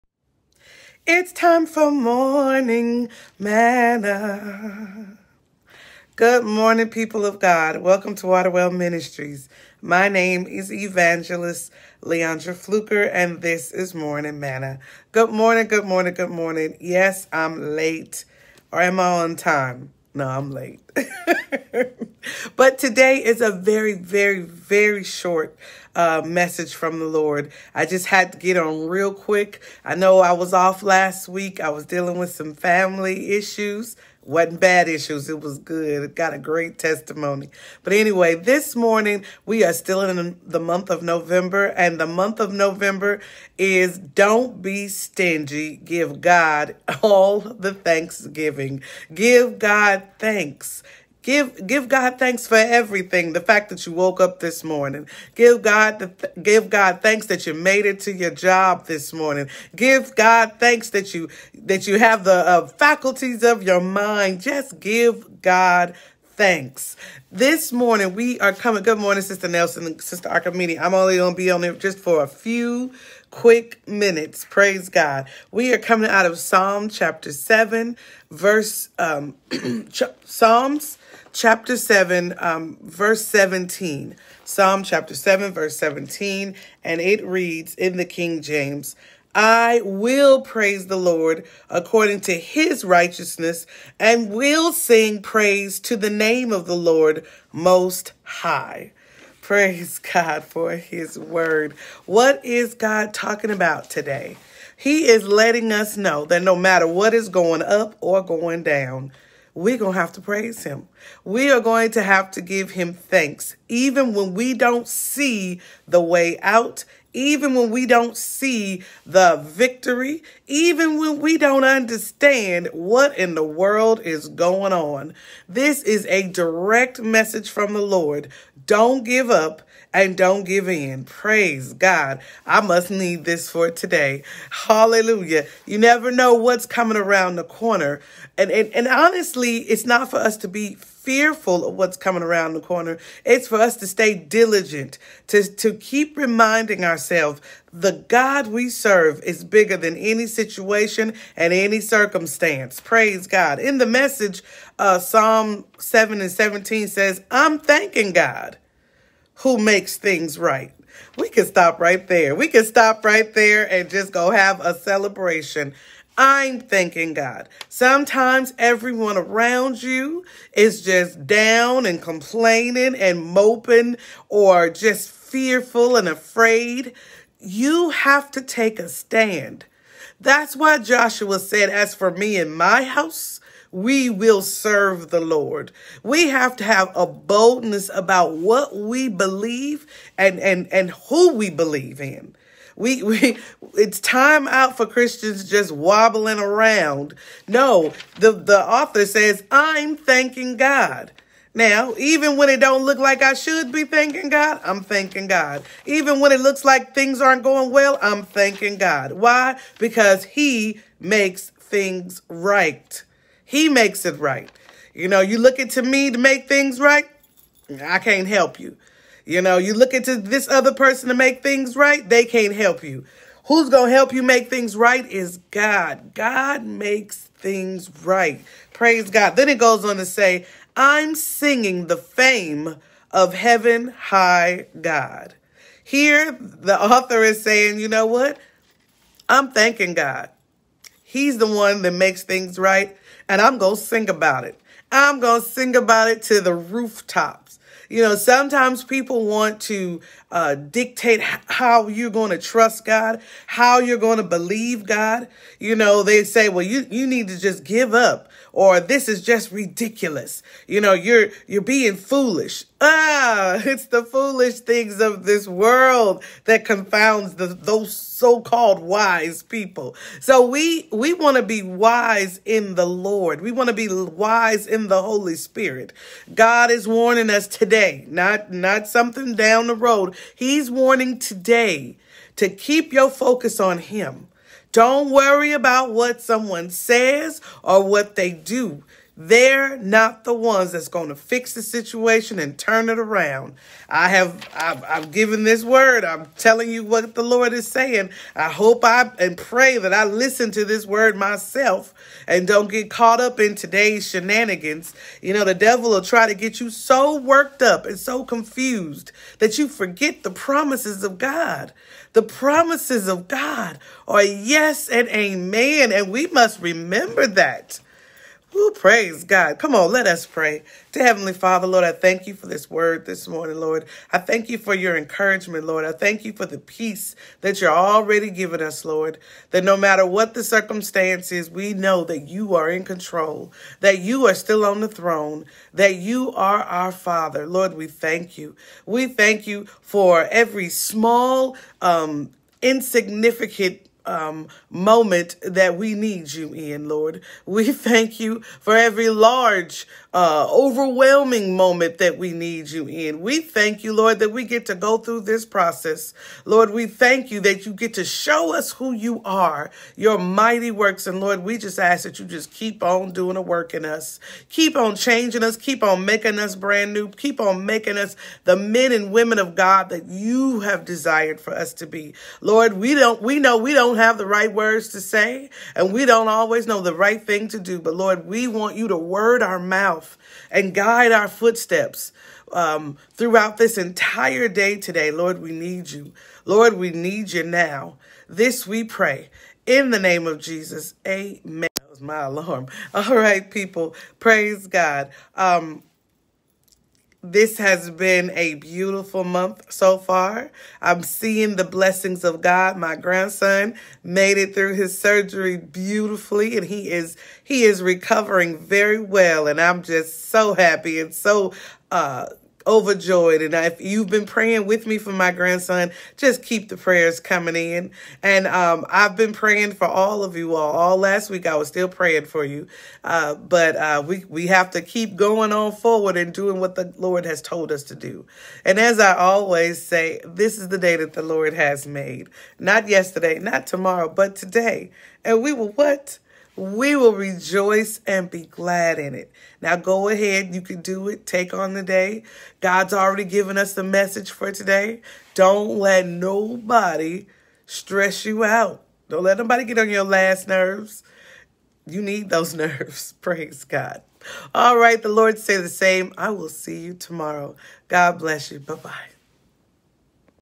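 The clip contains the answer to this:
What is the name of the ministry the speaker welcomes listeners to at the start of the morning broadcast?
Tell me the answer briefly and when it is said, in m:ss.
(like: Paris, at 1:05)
Waterwell Ministries, at 0:08.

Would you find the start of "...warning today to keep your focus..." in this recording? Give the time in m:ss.
4:40.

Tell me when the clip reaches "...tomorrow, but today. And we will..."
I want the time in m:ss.
7:13.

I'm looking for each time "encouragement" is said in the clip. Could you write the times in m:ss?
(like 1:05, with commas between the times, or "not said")
5:24.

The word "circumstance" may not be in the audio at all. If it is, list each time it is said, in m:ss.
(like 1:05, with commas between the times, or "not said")
2:31, 5:30.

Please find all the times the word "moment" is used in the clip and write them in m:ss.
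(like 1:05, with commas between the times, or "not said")
5:44, 5:51.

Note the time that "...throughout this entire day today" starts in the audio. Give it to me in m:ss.
6:23.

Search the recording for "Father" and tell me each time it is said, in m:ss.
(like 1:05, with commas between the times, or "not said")
5:21, 5:36.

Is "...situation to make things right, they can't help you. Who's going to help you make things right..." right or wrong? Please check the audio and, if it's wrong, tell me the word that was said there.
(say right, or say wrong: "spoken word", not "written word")
wrong: "person", not "situation".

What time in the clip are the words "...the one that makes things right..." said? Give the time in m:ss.
4:01.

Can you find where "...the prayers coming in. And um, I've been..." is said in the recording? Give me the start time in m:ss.
6:56.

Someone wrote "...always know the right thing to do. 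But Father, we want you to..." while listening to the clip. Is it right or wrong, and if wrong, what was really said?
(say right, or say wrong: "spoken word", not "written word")
wrong: "Lord", not "Father".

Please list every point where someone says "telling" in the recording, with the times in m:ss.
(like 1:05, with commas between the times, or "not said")
4:56.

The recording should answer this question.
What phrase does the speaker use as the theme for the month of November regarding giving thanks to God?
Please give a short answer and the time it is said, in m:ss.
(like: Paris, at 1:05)
Don't be stingy, at 0:43.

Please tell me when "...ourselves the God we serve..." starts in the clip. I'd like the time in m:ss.
2:26.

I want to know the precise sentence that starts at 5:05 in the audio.
You know, the devil will try to get you so worked up and so confused that you forget the promises of God.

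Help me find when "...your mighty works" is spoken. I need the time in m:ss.
5:59.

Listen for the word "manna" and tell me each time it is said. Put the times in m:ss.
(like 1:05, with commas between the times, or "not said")
0:03, 0:14.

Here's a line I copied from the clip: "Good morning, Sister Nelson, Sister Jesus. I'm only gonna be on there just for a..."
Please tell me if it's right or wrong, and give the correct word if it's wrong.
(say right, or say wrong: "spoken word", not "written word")
wrong: "Archimedes", not "Jesus".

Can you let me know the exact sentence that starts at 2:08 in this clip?
Don't give up and don't give in.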